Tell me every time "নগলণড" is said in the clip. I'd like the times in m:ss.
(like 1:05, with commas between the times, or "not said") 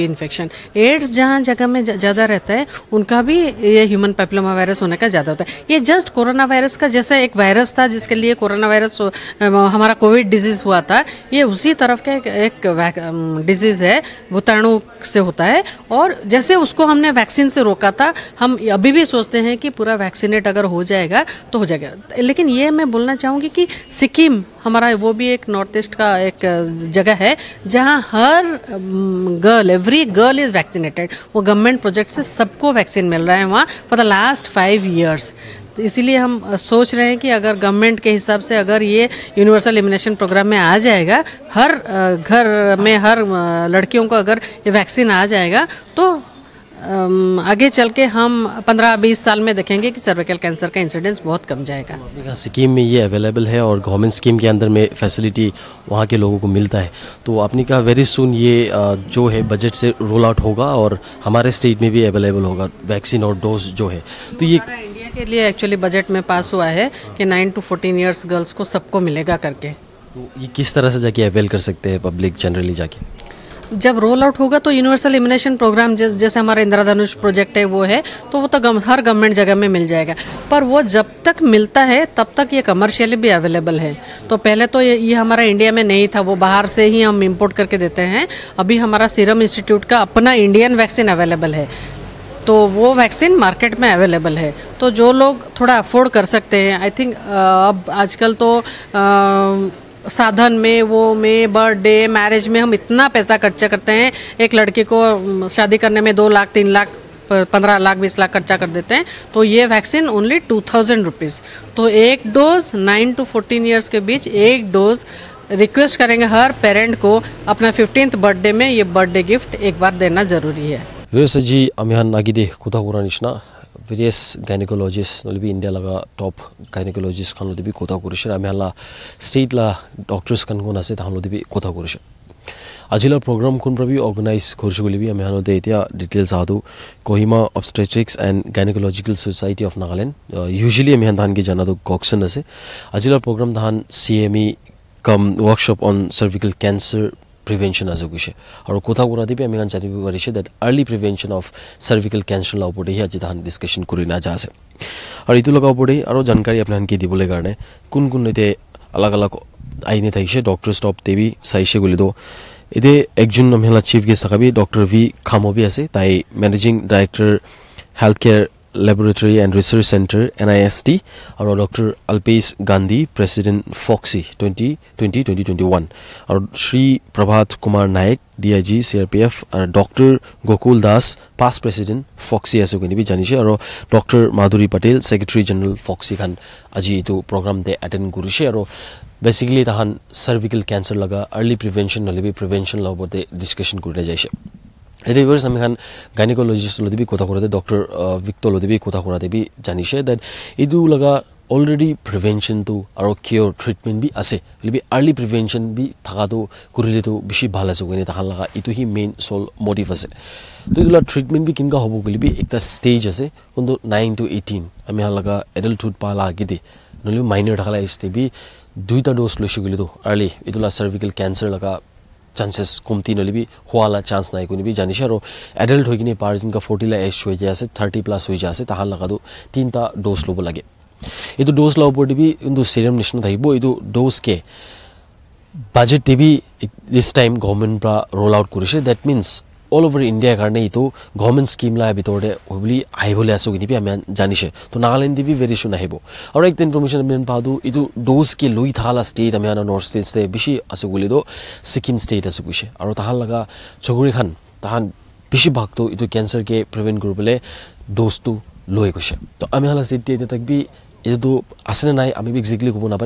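2:19, 4:04.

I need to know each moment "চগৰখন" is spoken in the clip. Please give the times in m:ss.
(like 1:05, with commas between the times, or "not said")
4:13.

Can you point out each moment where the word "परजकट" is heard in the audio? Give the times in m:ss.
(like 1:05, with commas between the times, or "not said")
0:31, 1:17.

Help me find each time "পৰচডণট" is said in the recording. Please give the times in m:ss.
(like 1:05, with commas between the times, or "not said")
2:53, 3:01.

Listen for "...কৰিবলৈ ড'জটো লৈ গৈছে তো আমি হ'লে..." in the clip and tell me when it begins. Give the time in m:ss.
4:17.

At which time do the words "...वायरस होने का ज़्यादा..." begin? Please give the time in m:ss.
0:04.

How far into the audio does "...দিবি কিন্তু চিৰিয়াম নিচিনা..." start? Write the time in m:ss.
3:52.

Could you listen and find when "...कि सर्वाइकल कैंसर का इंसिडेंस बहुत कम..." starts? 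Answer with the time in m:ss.
0:49.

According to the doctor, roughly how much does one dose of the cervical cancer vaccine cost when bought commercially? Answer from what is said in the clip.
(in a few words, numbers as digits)
2000 rupees.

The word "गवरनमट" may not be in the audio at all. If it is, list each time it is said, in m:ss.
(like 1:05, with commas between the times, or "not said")
0:31, 0:37, 0:53, 1:19.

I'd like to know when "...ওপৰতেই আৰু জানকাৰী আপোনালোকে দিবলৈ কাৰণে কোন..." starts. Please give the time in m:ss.
2:35.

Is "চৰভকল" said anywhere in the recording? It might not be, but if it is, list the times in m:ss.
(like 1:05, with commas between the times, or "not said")
2:26, 2:31, 3:10, 3:40.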